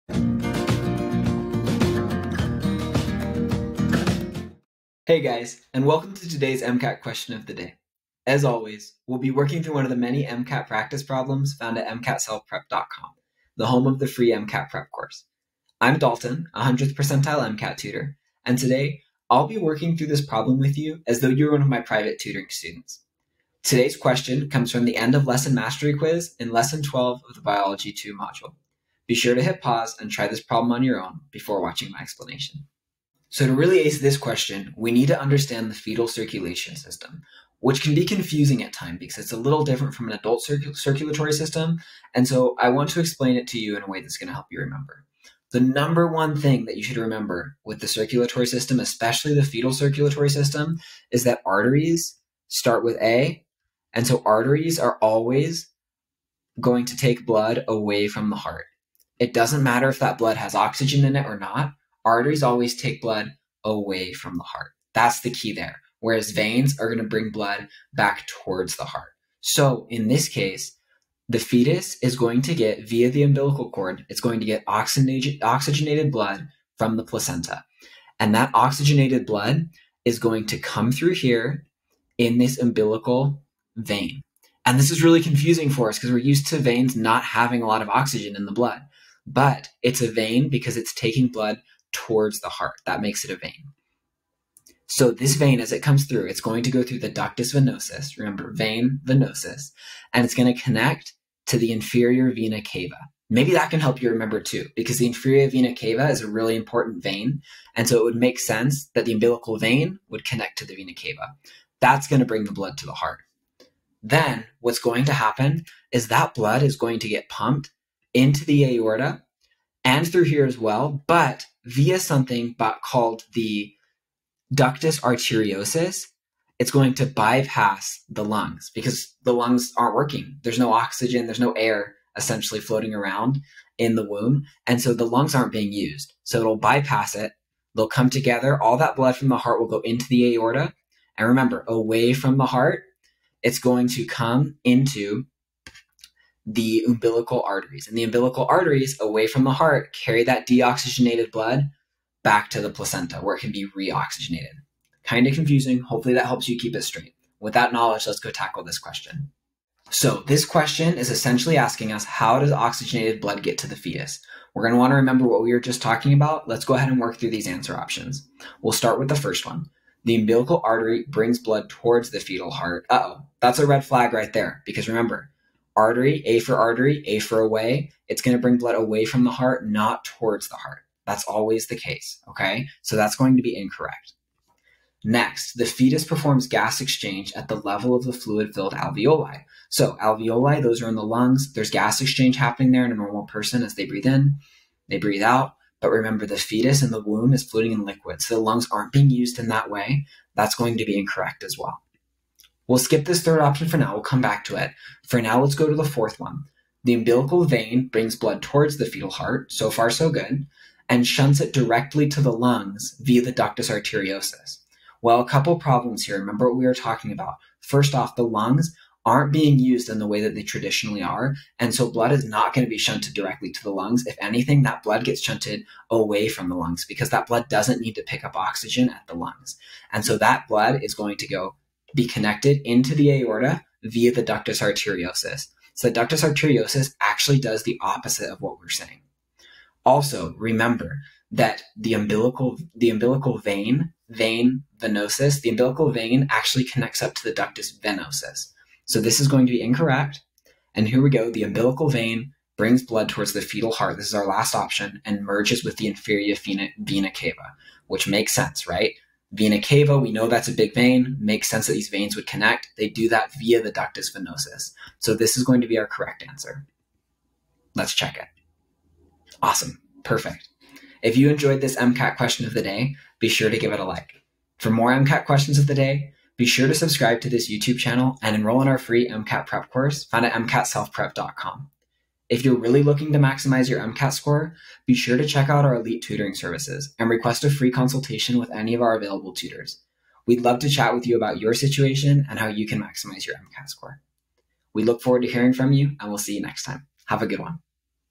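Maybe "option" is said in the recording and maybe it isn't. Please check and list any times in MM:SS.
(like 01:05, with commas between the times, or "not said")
02:47, 03:23, 04:14.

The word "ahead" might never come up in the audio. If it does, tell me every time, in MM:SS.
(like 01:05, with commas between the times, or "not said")
02:46.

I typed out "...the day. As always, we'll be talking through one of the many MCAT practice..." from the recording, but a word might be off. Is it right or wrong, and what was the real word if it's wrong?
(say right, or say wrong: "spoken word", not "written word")
wrong: "working", not "talking".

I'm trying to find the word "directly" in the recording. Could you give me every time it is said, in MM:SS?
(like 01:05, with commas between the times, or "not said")
03:31, 03:43.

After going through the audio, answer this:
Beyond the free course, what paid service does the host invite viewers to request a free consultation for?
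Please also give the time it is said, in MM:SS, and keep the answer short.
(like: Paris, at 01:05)
elite tutoring services, at 04:45.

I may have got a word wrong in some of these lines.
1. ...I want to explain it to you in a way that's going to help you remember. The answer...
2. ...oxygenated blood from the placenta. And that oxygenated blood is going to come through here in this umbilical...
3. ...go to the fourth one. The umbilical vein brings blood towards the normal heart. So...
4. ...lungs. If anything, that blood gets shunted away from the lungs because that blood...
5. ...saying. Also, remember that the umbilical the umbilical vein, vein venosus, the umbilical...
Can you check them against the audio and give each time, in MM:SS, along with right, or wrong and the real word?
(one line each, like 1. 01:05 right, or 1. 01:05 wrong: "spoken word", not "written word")
1. 00:42 wrong: "number", not "answer"
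2. 01:14 right
3. 03:25 wrong: "fetal", not "normal"
4. 03:43 right
5. 03:58 right.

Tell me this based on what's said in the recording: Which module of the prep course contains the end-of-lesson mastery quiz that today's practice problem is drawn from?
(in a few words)
Biology 2.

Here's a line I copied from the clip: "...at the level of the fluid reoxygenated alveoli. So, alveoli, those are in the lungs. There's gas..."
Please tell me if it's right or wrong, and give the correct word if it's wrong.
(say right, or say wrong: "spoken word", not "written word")
wrong: "filled", not "reoxygenated".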